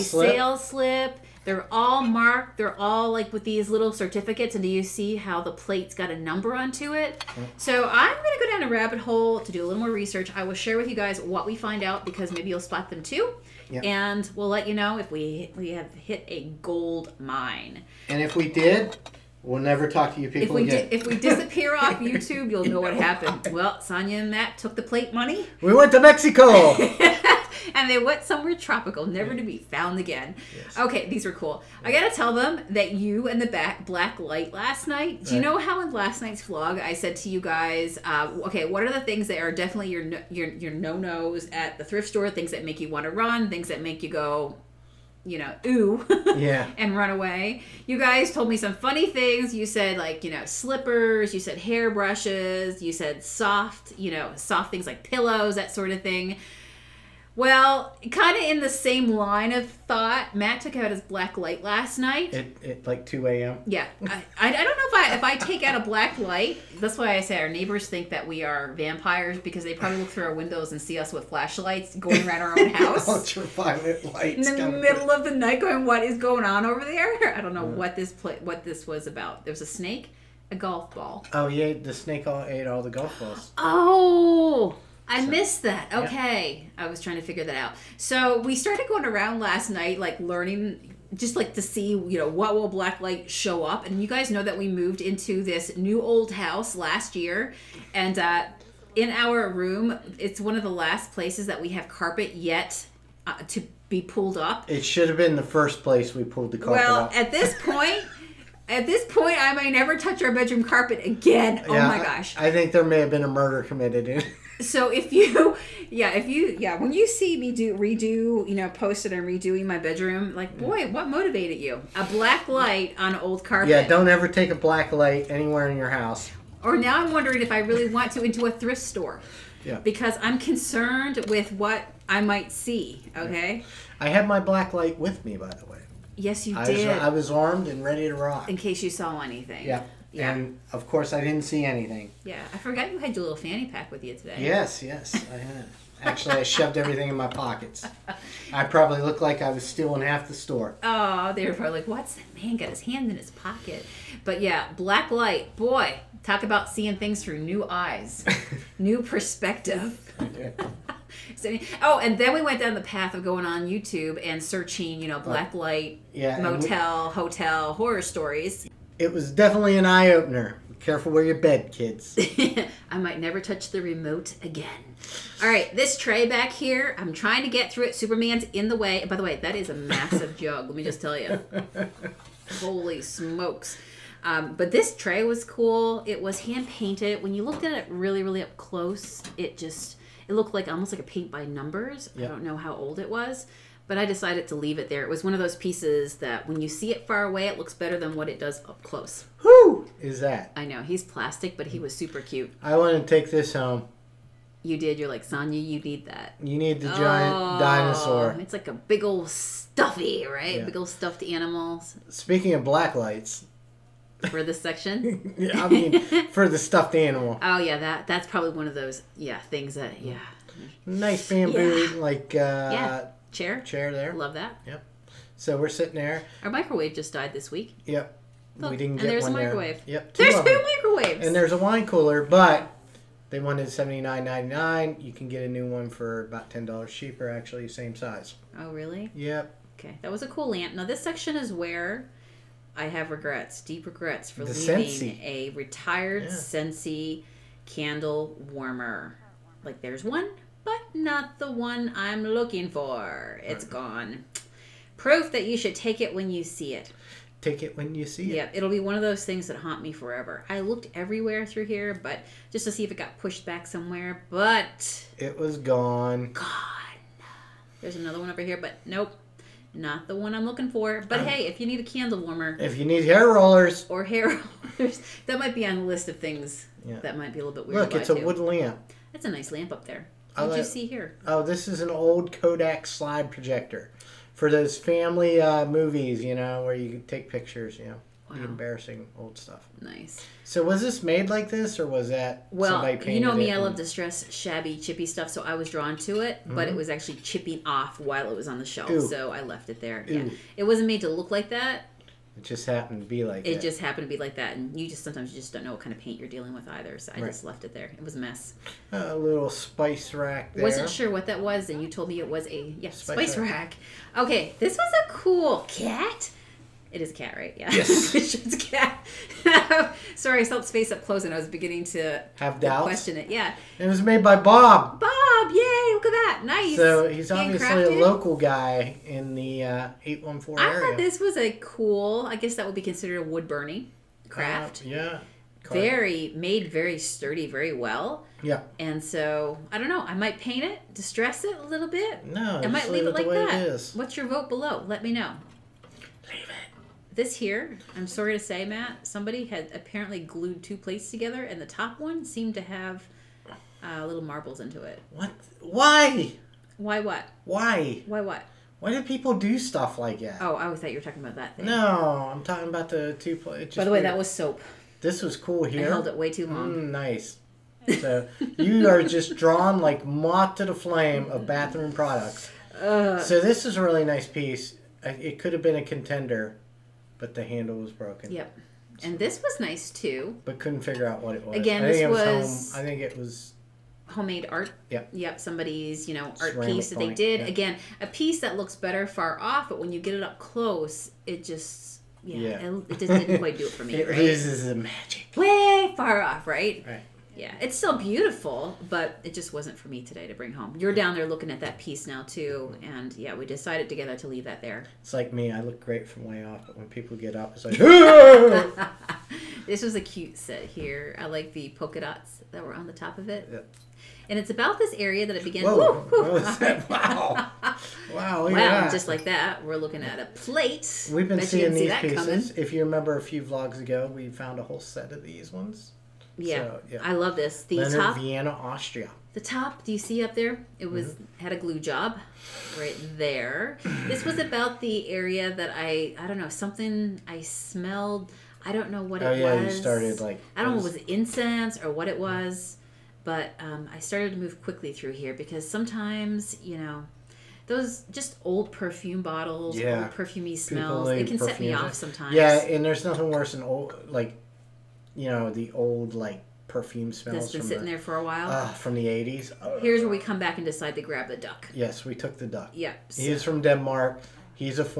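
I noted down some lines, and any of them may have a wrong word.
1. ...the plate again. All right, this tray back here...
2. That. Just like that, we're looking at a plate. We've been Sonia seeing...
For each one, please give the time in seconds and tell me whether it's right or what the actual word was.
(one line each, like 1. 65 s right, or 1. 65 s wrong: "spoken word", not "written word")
1. 173 s wrong: "remote", not "plate"
2. 418 s wrong: "Bet", not "Sonia".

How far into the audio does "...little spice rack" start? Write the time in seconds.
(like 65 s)
309 s.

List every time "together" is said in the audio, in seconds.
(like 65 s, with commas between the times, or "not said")
351 s, 403 s.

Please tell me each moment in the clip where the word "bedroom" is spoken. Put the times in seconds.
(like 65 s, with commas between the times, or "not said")
110 s, 119 s.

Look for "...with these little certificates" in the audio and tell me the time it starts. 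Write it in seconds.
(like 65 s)
3 s.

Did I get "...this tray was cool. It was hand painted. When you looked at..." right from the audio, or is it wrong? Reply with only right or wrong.
right.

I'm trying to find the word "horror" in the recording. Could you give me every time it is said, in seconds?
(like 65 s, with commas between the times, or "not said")
167 s.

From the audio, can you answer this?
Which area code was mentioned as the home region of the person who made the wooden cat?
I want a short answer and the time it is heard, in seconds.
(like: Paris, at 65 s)
814, at 330 s.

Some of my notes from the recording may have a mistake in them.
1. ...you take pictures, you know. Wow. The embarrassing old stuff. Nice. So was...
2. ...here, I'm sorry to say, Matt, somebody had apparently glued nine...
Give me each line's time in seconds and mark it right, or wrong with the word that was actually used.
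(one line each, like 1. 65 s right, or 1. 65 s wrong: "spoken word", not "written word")
1. 286 s right
2. 347 s wrong: "two", not "nine".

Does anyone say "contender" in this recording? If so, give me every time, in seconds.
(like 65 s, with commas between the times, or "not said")
375 s.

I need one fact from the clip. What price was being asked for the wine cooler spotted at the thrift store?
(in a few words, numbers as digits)
$79.99.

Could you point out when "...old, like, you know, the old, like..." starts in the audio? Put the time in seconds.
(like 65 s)
453 s.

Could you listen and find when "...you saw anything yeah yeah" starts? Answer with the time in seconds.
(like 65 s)
138 s.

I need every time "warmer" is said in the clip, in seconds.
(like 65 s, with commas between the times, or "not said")
248 s, 272 s.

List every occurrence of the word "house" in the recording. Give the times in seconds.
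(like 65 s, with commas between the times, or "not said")
72 s, 96 s, 125 s.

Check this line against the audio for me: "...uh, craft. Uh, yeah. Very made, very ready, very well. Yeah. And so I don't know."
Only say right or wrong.
wrong.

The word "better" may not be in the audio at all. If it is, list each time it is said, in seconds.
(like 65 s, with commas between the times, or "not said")
197 s, 388 s.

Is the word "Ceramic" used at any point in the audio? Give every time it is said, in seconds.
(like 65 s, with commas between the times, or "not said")
386 s.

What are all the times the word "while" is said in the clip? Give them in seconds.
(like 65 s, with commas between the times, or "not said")
297 s, 458 s.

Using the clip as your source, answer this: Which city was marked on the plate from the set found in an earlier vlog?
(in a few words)
Vienna, Austria.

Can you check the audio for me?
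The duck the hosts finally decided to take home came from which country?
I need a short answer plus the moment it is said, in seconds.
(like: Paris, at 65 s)
Denmark, at 463 s.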